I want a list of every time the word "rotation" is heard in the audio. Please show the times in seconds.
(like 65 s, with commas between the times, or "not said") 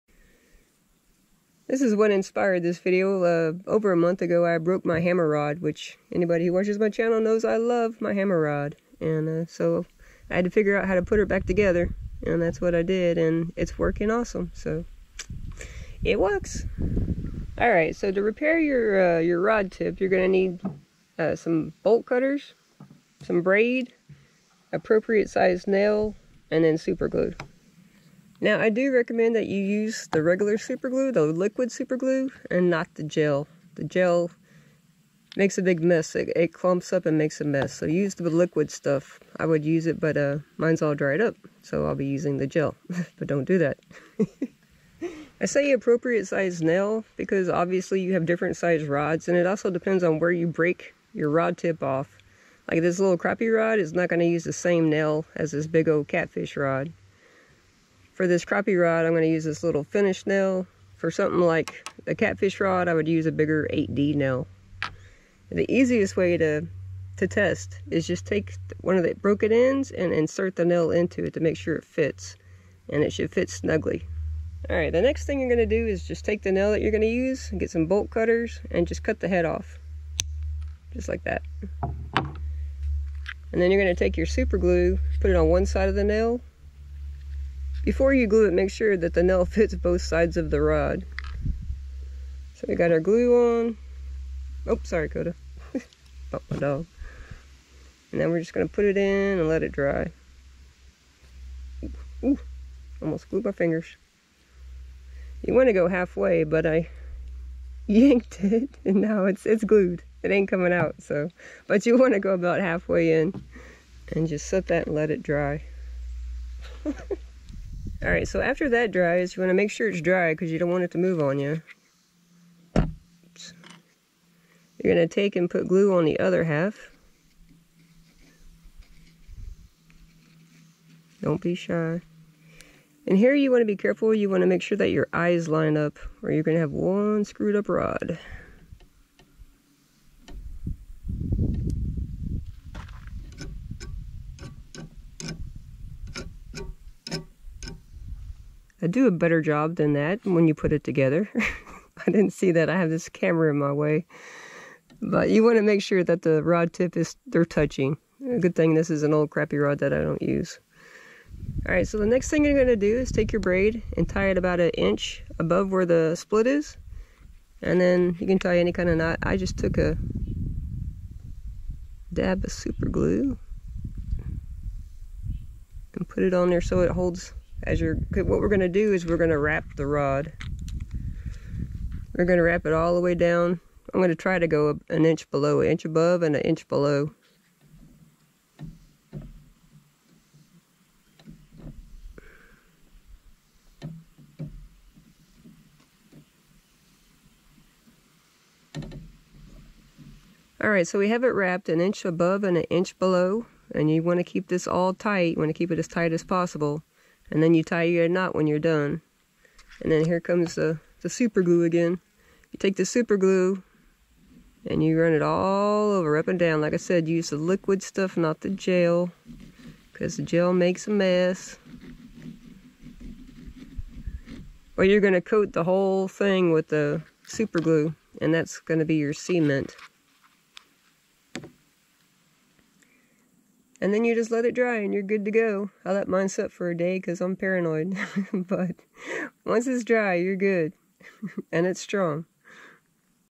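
not said.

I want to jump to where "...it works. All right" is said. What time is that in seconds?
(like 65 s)
16 s.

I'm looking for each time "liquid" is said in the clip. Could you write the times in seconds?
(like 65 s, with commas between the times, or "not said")
31 s, 38 s, 217 s.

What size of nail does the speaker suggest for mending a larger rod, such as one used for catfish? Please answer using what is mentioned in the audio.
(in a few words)
8D nail.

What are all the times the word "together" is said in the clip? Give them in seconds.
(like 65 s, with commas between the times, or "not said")
11 s, 150 s.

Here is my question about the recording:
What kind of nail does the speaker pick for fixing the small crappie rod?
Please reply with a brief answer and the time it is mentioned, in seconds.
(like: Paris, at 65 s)
finish nail, at 59 s.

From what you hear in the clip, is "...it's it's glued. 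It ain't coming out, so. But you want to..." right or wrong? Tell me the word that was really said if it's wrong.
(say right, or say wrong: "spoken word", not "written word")
right.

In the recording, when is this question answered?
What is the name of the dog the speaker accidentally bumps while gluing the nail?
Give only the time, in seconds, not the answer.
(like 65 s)
95 s.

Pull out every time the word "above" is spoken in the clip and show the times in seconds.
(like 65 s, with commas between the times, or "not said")
165 s, 185 s, 202 s.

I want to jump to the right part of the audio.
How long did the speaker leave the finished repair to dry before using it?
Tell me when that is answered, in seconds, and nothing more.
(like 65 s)
236 s.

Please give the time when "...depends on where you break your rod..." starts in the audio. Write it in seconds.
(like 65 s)
49 s.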